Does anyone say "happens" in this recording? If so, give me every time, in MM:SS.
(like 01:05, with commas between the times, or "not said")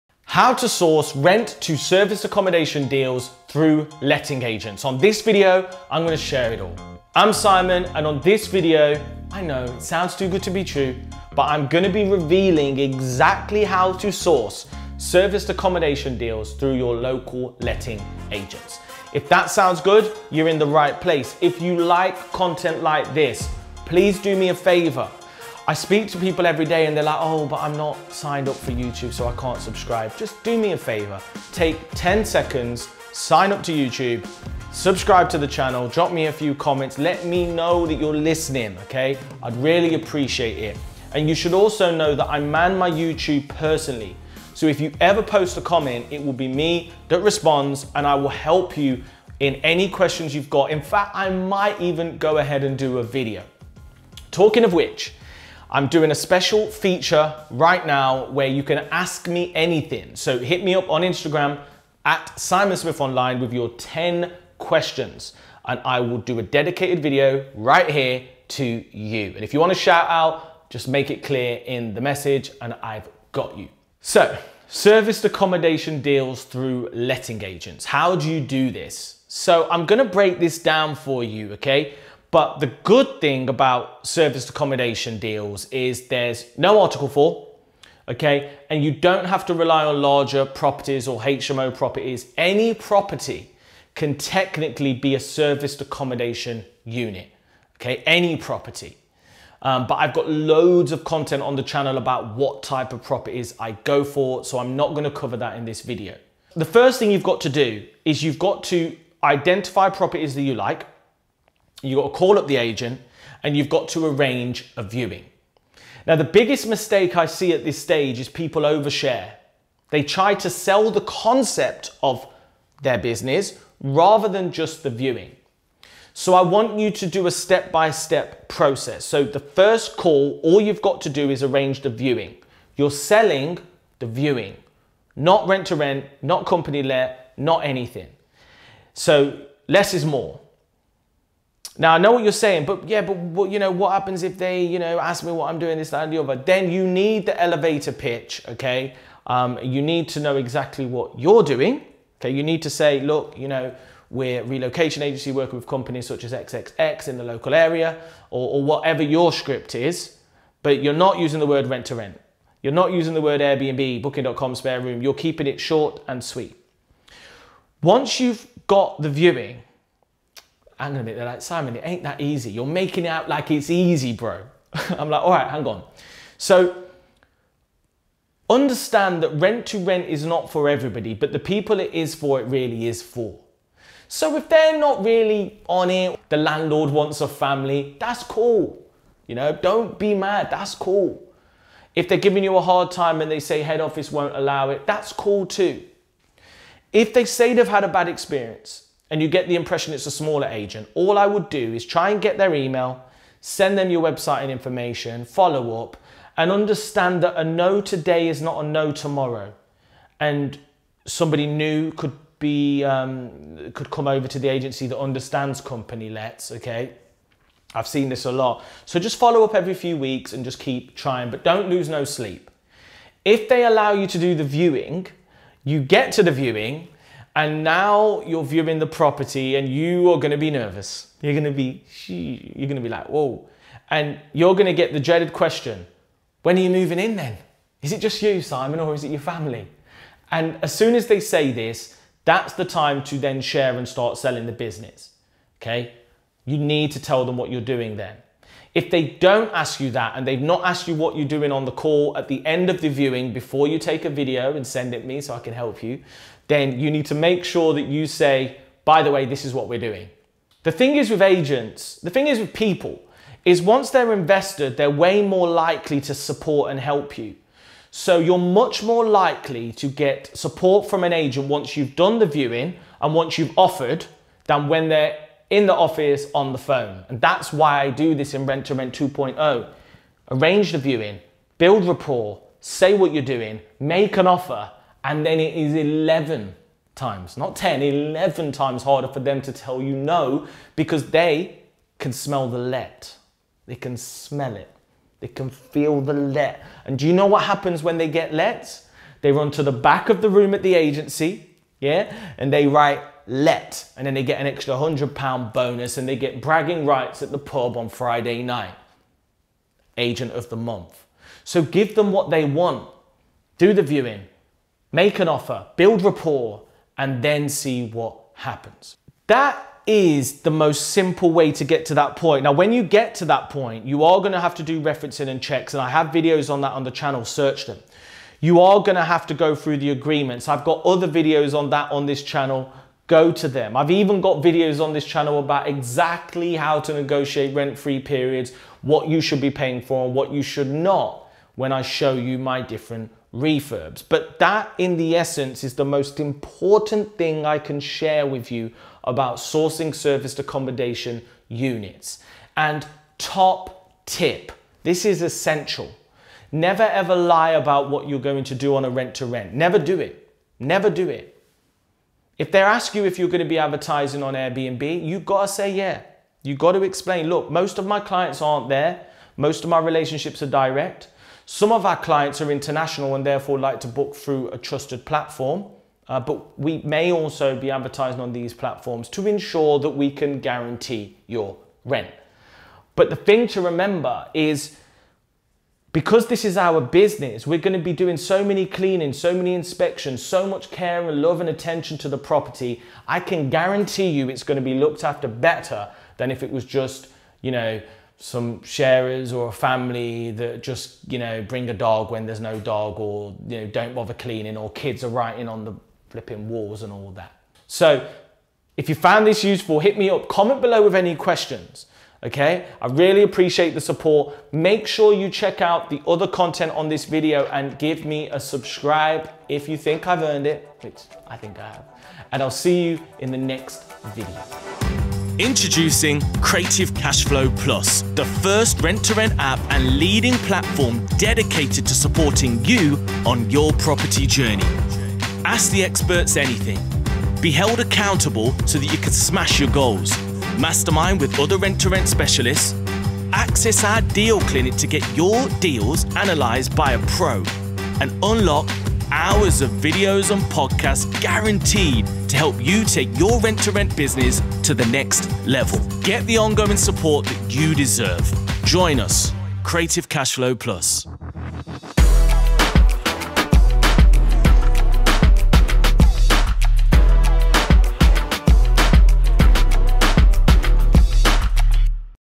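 02:23, 04:57, 05:18.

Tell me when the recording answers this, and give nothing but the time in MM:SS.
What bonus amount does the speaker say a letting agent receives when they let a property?
05:04.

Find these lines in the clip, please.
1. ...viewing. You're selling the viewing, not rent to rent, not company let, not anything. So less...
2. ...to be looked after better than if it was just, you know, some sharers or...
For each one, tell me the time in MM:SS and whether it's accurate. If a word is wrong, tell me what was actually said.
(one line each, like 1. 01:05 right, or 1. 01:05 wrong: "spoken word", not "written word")
1. 02:11 right
2. 06:34 right.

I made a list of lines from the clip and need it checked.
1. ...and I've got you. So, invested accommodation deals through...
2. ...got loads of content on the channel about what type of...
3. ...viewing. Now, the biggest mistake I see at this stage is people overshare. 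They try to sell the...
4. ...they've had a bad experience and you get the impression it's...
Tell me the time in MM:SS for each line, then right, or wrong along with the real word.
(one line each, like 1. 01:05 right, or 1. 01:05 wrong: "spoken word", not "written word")
1. 01:12 wrong: "serviced", not "invested"
2. 01:40 right
3. 01:54 right
4. 03:17 right.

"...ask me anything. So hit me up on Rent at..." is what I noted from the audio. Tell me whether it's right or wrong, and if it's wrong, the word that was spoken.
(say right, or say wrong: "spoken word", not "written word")
wrong: "Instagram", not "Rent".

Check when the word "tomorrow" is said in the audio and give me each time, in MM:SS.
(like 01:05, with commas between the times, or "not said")
03:28.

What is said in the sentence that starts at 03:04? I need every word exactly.
So if they're not really on it, the landlord wants a family, that's cool.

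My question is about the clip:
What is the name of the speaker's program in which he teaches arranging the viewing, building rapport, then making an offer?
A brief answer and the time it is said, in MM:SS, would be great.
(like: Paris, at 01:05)
Rent to Rent 2.0, at 04:38.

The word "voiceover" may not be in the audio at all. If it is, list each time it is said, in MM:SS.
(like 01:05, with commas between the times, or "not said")
not said.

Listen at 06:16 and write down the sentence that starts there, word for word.
Uh, but we may also be advertising on these platforms to ensure that we can guarantee your rent.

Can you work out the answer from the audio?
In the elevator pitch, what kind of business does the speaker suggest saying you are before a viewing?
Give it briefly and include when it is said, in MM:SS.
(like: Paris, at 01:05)
Relocation agency, at 02:34.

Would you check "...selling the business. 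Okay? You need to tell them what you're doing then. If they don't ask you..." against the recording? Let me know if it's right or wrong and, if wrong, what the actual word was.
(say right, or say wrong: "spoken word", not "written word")
right.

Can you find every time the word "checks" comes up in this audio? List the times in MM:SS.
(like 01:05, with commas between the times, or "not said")
05:25, 06:55.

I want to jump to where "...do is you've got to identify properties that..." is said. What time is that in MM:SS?
01:47.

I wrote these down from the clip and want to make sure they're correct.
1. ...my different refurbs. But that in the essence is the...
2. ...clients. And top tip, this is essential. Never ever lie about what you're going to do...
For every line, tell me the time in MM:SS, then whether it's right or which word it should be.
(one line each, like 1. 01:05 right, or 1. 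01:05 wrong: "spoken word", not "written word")
1. 05:42 right
2. 05:51 wrong: "units", not "clients".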